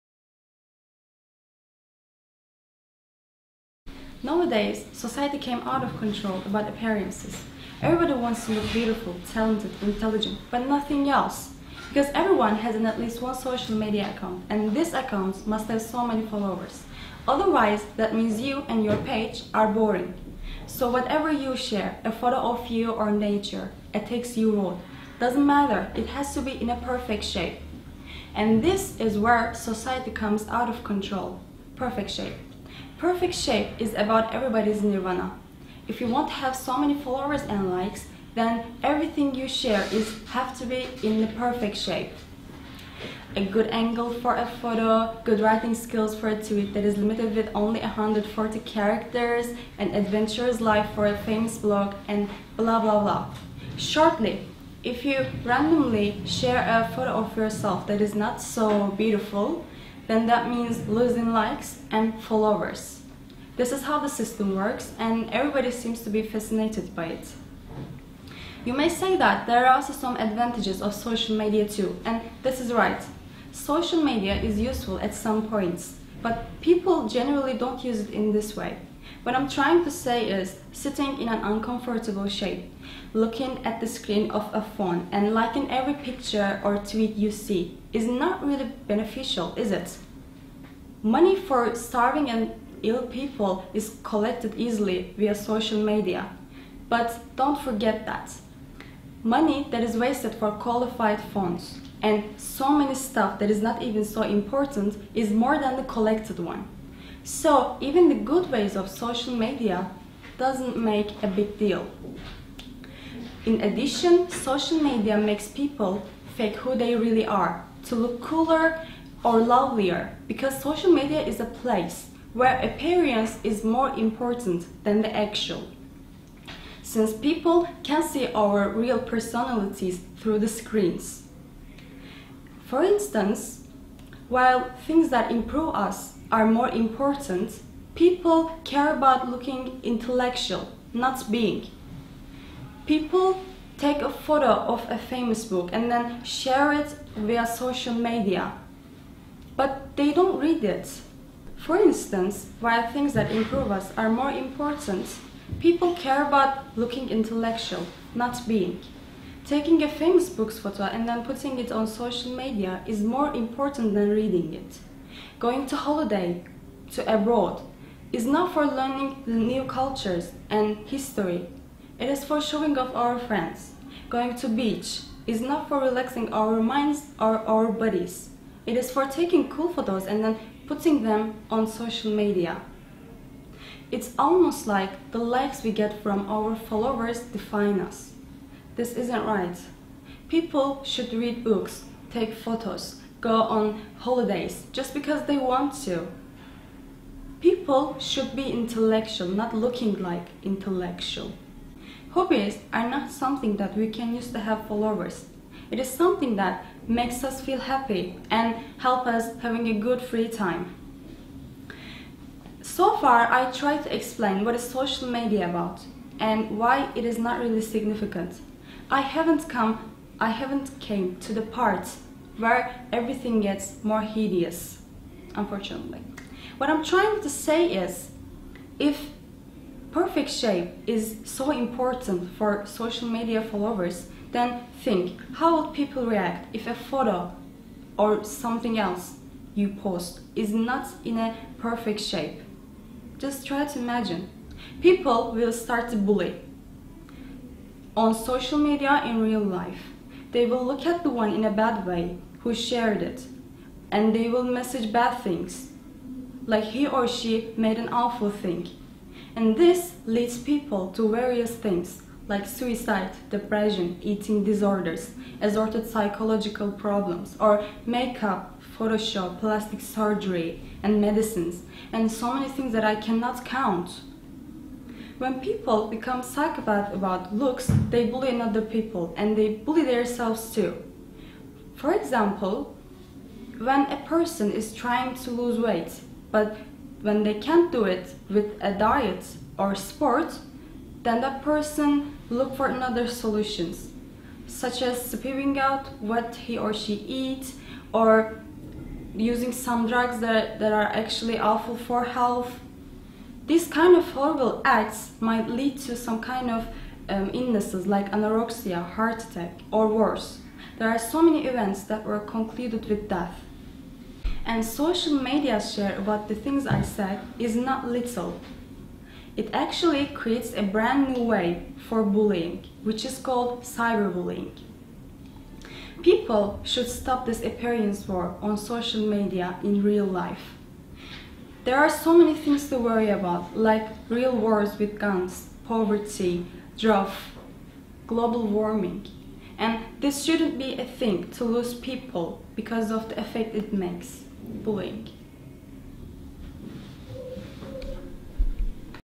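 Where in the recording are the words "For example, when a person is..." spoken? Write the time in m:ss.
4:41.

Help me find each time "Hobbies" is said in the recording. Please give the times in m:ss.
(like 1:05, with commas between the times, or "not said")
3:22.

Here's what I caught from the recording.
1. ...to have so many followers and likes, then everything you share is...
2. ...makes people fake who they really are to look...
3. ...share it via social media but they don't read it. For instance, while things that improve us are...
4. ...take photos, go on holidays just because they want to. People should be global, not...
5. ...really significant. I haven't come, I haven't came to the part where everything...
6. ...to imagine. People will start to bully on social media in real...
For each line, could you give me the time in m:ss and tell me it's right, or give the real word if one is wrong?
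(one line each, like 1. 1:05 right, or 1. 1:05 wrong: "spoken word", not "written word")
1. 0:36 right
2. 1:55 right
3. 2:26 right
4. 3:12 wrong: "intellectual", not "global"
5. 3:37 right
6. 4:03 right.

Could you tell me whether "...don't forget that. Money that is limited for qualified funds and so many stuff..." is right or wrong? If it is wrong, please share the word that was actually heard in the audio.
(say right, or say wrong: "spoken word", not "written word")
wrong: "wasted", not "limited".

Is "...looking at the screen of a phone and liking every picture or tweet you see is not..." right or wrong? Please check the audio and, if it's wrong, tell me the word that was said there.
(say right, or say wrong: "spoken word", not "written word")
right.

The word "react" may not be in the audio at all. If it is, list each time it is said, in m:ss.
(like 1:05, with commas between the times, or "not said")
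3:56.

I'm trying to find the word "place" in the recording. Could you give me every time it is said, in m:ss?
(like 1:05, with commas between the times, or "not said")
2:01.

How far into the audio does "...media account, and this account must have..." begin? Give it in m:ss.
0:13.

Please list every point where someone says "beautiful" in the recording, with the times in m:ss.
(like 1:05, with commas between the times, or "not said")
0:08, 0:58.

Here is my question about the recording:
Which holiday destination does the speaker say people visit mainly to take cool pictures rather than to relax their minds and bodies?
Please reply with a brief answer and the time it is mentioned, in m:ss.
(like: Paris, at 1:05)
beach, at 2:54.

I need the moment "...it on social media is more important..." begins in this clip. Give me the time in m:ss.
2:41.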